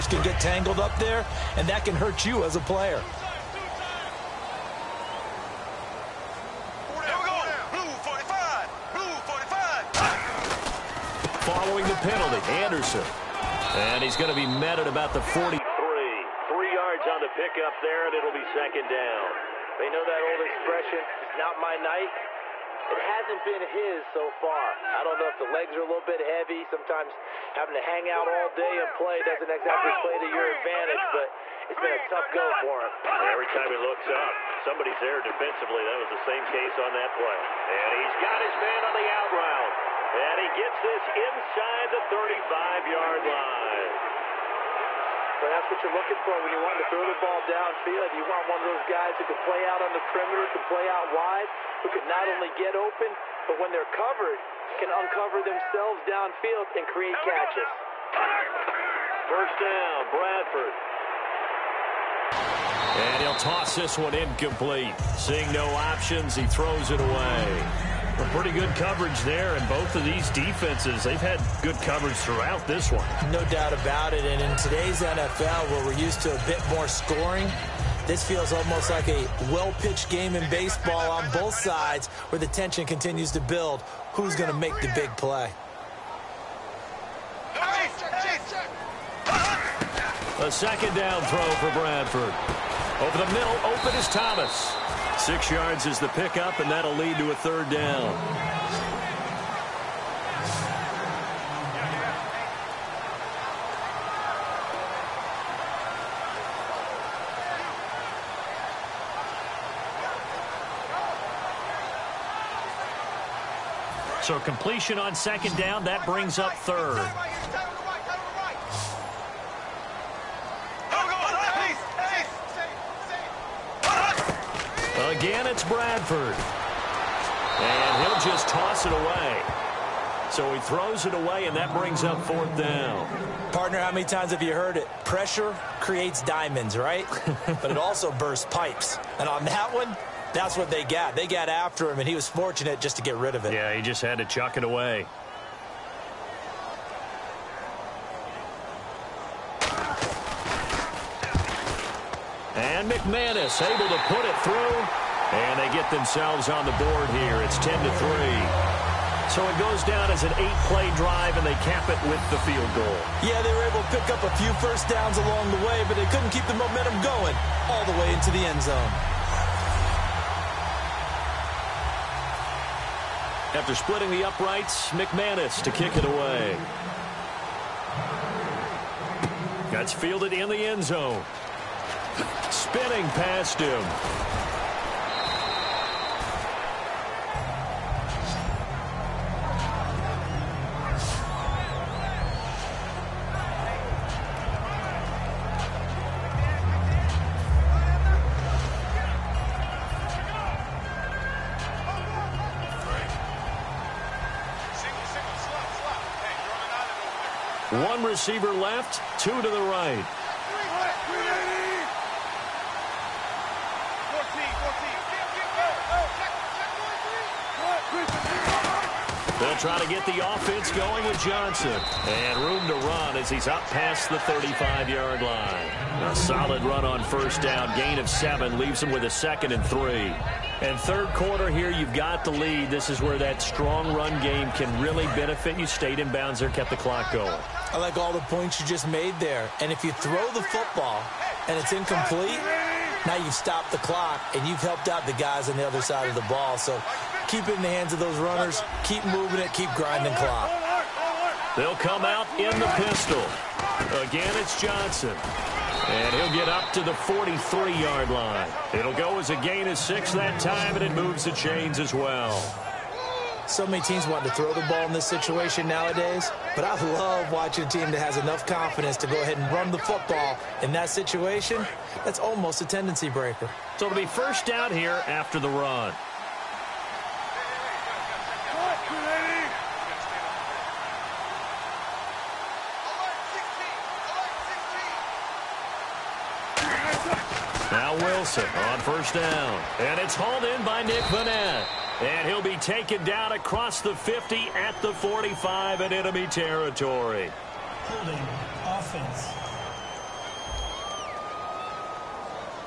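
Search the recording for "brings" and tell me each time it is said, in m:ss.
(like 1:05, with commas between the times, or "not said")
1:56, 2:11.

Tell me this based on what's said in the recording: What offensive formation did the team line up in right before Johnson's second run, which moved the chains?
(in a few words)
pistol.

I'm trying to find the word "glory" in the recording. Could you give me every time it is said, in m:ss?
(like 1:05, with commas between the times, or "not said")
not said.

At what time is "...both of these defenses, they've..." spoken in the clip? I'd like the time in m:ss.
1:09.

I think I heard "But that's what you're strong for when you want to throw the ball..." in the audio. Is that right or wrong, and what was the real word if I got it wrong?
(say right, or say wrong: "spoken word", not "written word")
wrong: "looking", not "strong".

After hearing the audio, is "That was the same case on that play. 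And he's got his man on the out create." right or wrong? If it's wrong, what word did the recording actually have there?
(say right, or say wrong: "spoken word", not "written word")
wrong: "route", not "create".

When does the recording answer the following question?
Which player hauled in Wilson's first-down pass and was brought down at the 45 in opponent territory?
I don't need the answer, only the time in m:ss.
4:50.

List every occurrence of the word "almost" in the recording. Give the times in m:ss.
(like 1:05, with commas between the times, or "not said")
1:18, 4:32.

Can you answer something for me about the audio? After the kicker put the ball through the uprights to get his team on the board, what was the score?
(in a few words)
10 to 3.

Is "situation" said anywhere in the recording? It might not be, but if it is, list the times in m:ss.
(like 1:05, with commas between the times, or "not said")
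4:25, 4:30.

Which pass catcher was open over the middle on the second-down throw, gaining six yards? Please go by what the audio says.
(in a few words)
Thomas.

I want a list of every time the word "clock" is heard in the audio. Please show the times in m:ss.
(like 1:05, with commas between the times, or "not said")
3:56, 4:03, 4:10.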